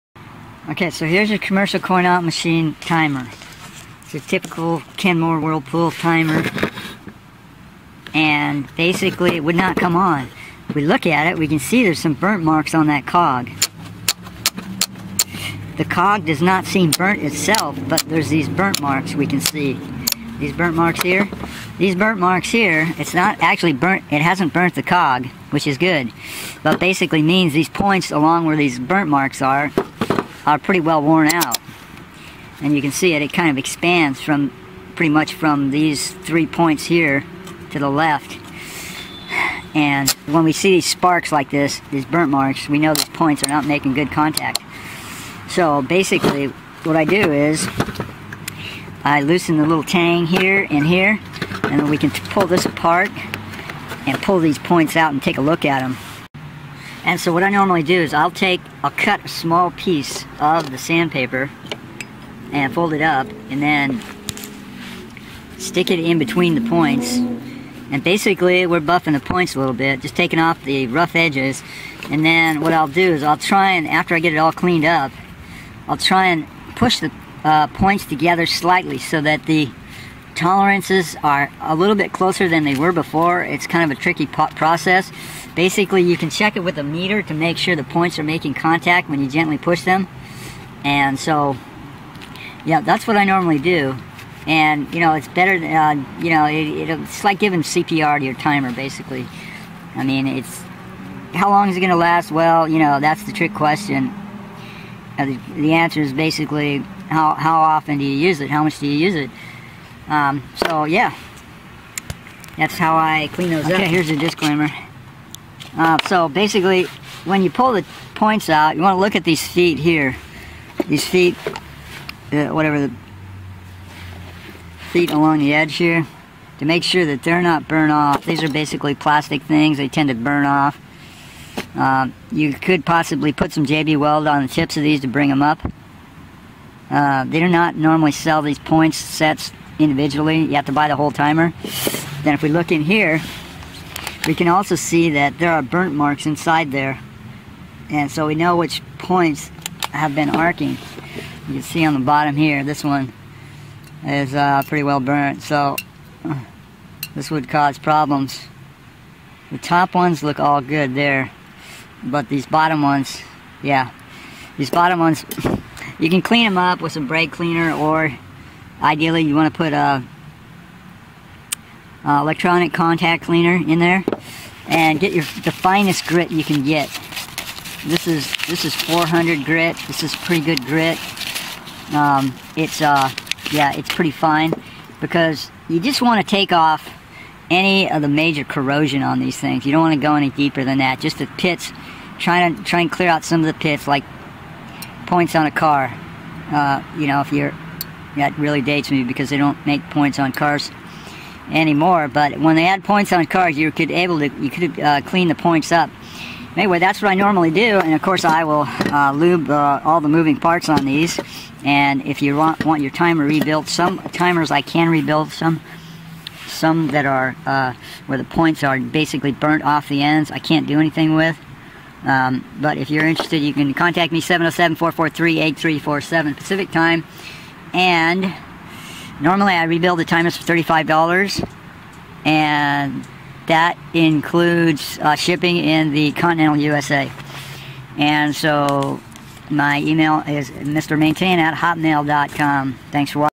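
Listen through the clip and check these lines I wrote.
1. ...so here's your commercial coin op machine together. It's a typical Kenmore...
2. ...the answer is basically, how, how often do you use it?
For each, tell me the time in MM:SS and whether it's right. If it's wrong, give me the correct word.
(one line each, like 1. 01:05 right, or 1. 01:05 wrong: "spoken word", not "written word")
1. 00:00 wrong: "timer", not "together"
2. 01:45 right.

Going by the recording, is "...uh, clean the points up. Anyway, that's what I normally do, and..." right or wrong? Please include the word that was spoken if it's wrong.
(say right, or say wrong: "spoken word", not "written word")
right.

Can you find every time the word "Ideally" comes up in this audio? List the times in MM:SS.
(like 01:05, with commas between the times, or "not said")
02:48.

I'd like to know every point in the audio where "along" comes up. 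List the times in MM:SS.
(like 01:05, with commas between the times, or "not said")
00:28, 02:05.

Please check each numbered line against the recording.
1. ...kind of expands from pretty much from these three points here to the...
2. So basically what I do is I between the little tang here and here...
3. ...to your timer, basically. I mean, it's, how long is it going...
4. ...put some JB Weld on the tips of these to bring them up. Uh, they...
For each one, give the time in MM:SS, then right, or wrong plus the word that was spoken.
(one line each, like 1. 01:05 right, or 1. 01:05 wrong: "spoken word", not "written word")
1. 00:33 right
2. 00:45 wrong: "loosen", not "between"
3. 01:38 right
4. 02:13 right.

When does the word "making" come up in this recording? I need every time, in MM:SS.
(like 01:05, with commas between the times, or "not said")
00:43, 01:28.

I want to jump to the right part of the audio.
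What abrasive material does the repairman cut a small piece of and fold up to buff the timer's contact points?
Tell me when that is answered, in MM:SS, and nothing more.
01:00.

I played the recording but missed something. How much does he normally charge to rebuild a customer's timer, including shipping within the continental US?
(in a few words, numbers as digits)
$35.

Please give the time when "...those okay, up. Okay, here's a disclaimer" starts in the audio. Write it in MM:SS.
01:53.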